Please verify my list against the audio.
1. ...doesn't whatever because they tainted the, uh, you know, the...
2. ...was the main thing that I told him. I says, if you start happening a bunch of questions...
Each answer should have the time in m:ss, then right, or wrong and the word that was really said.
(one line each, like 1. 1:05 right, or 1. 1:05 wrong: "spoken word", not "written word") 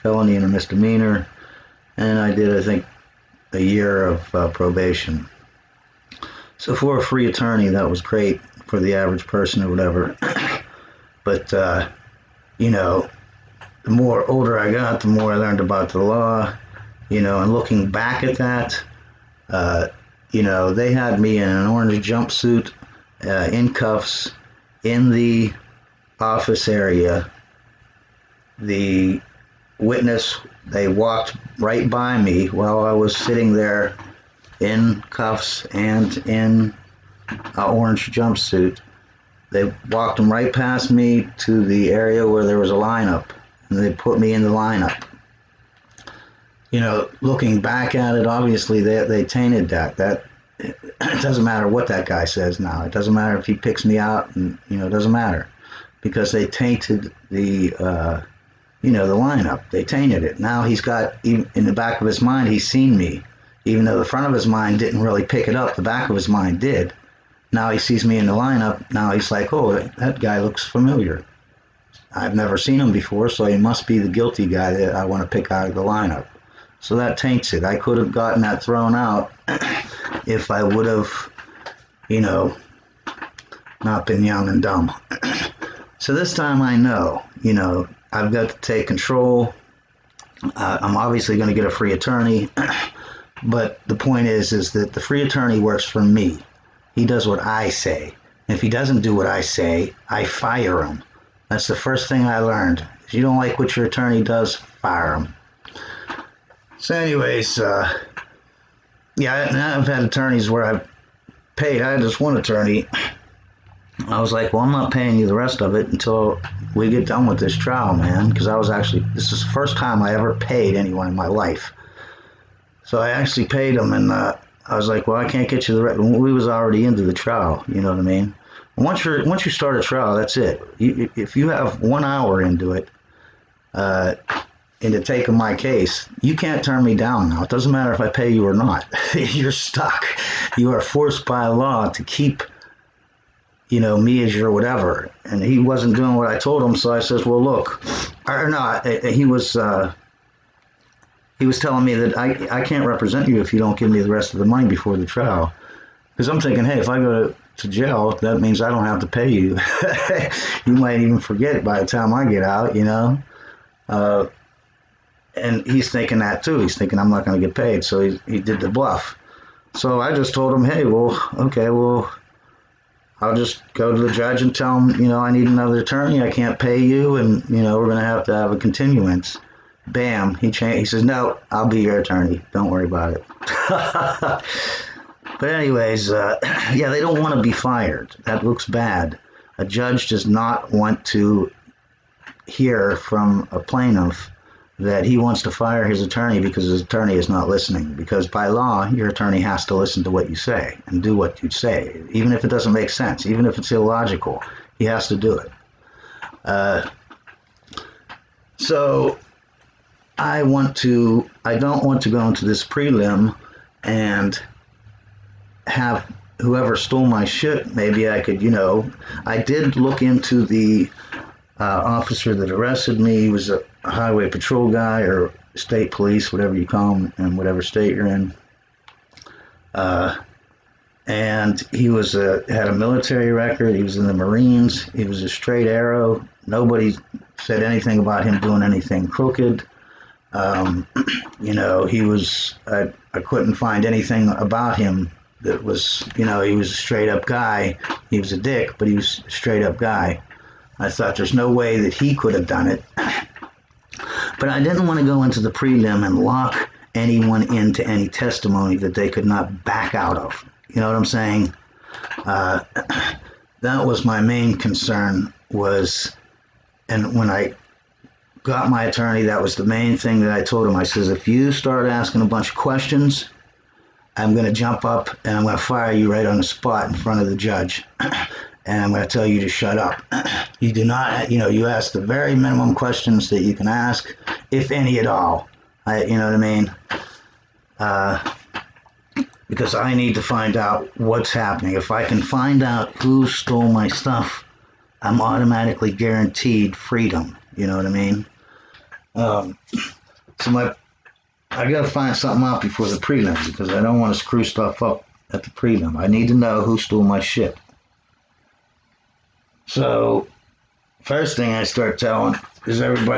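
1. 0:54 wrong: "matter", not "whatever"
2. 4:29 wrong: "asking", not "happening".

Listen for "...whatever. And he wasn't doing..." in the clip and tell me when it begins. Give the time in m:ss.
2:24.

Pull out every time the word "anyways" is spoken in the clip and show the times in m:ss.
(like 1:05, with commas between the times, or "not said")
1:46, 3:05.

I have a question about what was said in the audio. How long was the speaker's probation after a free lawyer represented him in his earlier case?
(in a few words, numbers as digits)
1 year.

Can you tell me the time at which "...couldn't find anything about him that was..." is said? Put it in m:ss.
4:03.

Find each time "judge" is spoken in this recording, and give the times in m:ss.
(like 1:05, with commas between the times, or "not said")
2:54, 3:09, 4:37.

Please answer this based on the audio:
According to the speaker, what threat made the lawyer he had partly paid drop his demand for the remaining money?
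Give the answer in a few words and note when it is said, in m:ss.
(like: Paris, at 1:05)
a continuance, at 2:58.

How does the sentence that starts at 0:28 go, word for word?
The witness, they walked right by me while I was sitting there in cuffs and in an orange jumpsuit.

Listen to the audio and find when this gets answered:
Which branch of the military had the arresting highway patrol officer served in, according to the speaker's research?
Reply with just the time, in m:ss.
3:54.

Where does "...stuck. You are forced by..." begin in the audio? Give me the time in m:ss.
2:19.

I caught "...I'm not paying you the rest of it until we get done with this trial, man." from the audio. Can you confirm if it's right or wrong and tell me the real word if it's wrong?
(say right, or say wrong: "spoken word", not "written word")
right.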